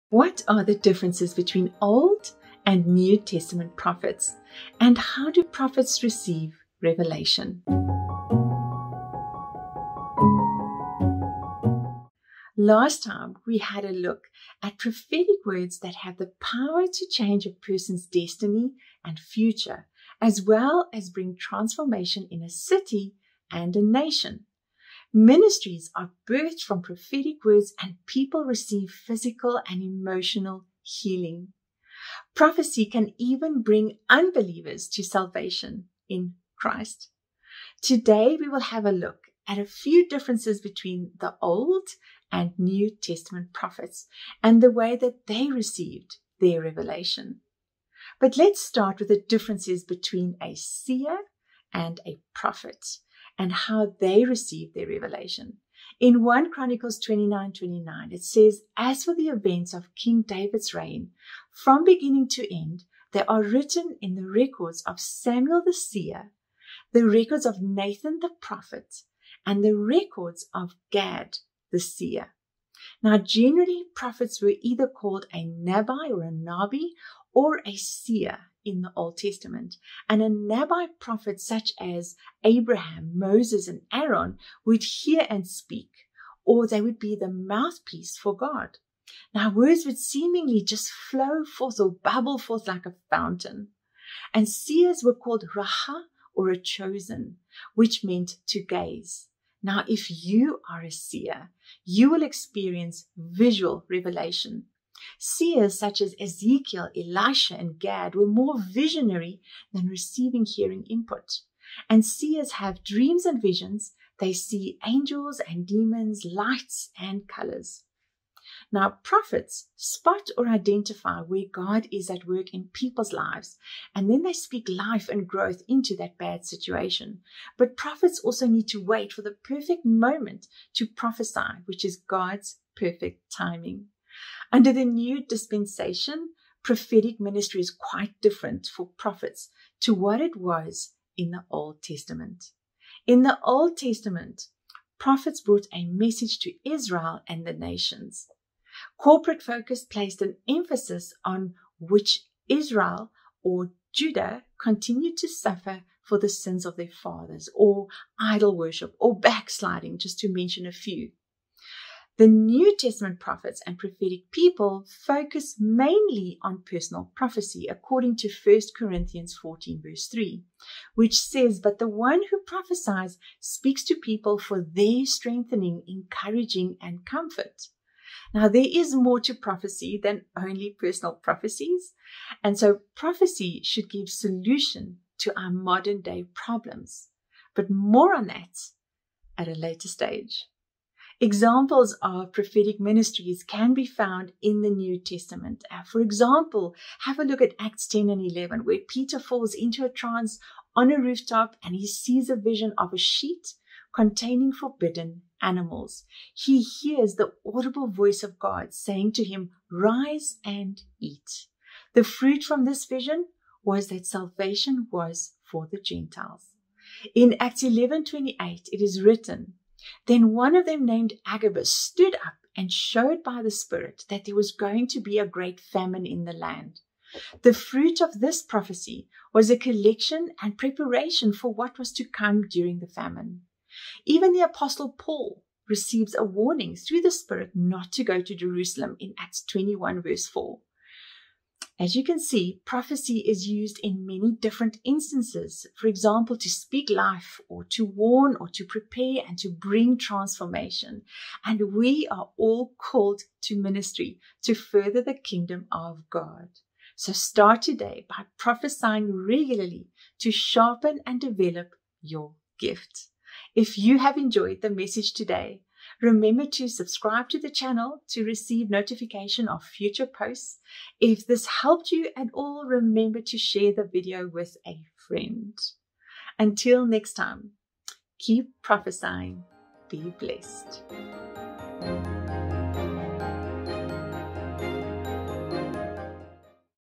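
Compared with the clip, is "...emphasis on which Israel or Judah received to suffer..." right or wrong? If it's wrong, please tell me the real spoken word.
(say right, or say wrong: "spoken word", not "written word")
wrong: "continued", not "received".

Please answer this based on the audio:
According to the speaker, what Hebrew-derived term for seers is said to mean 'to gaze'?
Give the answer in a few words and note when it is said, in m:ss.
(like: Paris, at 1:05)
Raha, at 1:35.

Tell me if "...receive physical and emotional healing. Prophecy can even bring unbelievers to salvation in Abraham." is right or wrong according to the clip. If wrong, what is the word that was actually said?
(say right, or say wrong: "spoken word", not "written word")
wrong: "Christ", not "Abraham".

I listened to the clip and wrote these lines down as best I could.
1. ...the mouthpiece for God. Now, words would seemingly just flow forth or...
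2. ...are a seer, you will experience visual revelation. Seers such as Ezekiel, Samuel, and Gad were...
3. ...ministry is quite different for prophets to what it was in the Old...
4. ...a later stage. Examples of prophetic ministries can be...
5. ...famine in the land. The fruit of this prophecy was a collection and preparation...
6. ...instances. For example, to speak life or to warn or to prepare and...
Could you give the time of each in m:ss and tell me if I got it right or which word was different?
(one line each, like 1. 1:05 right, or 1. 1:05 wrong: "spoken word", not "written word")
1. 1:27 right
2. 1:40 wrong: "Elisha", not "Samuel"
3. 2:17 right
4. 3:09 right
5. 3:45 right
6. 4:04 right.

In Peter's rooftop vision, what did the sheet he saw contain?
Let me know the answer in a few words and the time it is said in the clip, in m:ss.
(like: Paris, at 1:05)
Forbidden animals, at 3:24.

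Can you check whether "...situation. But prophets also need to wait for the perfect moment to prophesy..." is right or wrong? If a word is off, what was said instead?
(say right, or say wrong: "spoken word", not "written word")
right.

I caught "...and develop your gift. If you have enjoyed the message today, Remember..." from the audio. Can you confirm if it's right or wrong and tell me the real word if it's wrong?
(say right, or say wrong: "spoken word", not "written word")
right.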